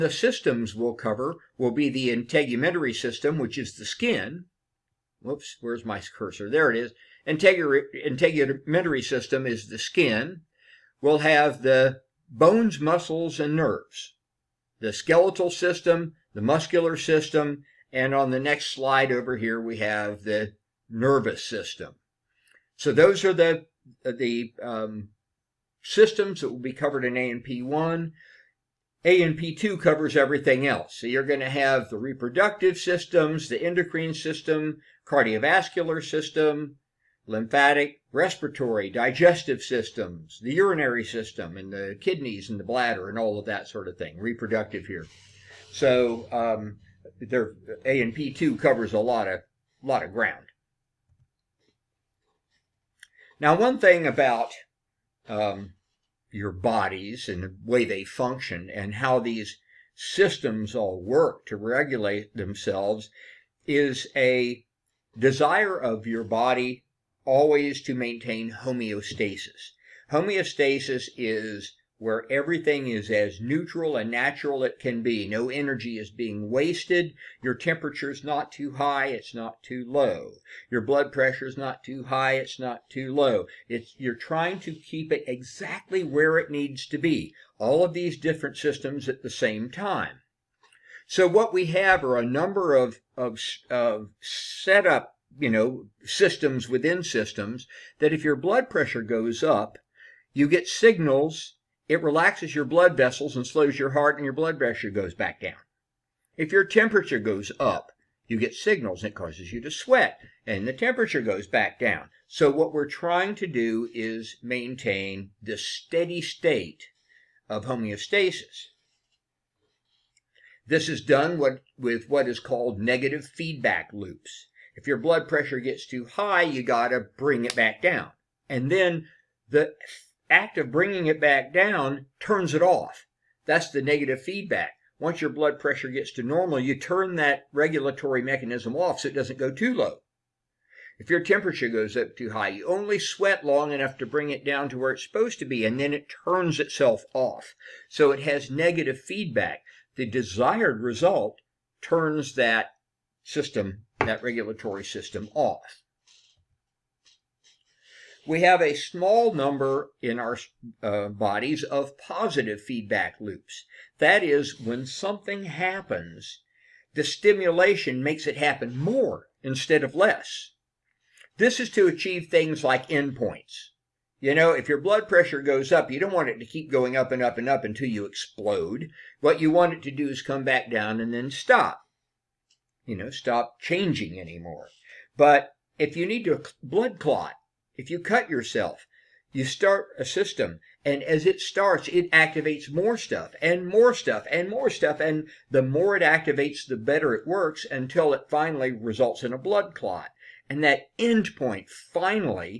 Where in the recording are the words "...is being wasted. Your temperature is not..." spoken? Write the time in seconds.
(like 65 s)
75 s.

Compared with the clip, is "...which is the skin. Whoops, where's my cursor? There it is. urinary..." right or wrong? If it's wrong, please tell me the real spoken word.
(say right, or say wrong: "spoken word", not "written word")
wrong: "integumentary", not "urinary".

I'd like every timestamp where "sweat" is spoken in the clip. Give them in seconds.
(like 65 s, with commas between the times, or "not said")
109 s, 142 s.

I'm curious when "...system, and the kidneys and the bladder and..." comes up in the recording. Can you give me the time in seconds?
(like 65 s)
41 s.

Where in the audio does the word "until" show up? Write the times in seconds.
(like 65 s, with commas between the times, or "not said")
177 s, 197 s.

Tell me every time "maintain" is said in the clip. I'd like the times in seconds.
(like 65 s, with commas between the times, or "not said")
67 s, 114 s.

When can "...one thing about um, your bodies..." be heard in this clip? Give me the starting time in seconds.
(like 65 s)
53 s.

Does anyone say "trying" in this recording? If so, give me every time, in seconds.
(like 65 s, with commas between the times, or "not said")
84 s, 112 s.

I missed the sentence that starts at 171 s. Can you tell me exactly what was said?
This is to achieve things like endpoints.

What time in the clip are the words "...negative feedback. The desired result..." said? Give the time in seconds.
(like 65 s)
148 s.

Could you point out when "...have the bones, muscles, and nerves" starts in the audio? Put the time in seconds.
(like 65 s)
11 s.